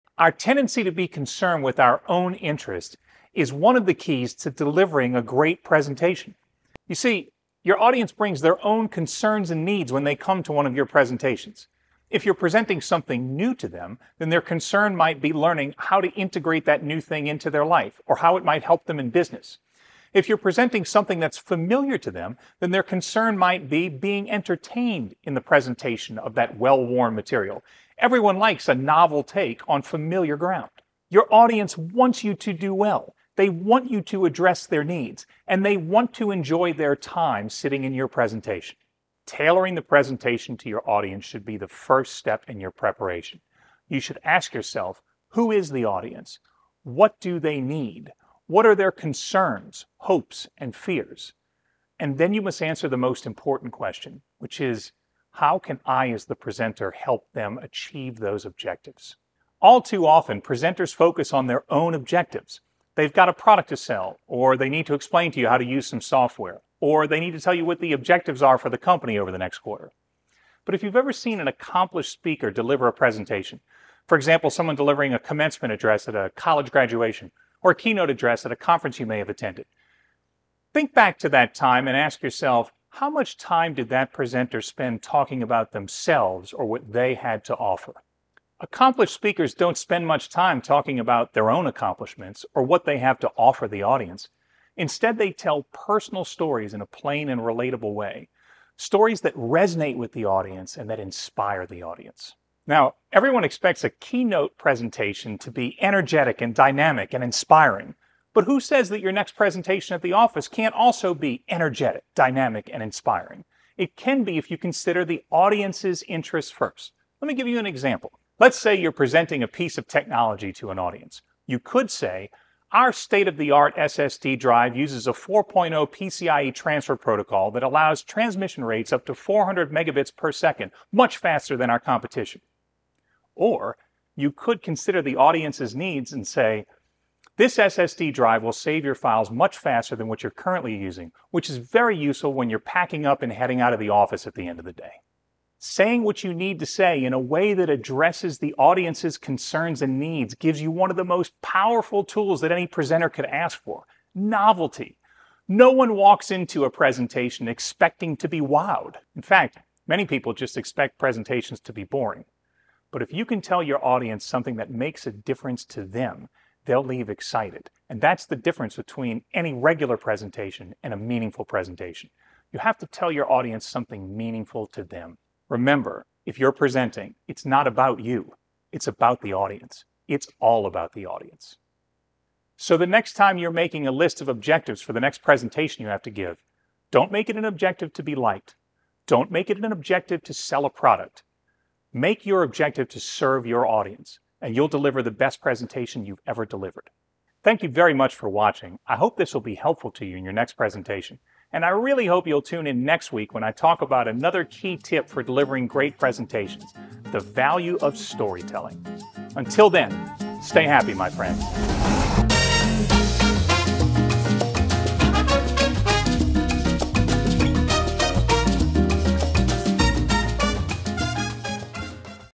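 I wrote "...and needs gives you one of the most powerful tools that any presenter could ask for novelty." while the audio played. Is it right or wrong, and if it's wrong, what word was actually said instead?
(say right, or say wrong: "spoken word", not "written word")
right.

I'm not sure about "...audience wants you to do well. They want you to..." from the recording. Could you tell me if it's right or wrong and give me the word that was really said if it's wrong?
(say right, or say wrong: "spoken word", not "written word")
right.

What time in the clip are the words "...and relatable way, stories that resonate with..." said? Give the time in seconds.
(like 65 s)
97 s.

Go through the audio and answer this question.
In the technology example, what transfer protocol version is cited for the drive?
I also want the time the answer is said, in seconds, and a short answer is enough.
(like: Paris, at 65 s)
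4.0 PCIe, at 125 s.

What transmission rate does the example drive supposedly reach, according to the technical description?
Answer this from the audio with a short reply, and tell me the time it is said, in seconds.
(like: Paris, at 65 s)
400 megabits per second, at 129 s.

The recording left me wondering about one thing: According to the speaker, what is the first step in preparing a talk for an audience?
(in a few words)
Tailoring the presentation to your audience.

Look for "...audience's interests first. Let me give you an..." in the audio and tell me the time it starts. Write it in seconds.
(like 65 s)
115 s.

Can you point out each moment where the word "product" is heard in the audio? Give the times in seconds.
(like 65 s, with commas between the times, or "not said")
63 s, 190 s.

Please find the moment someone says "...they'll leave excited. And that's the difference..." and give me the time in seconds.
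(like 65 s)
166 s.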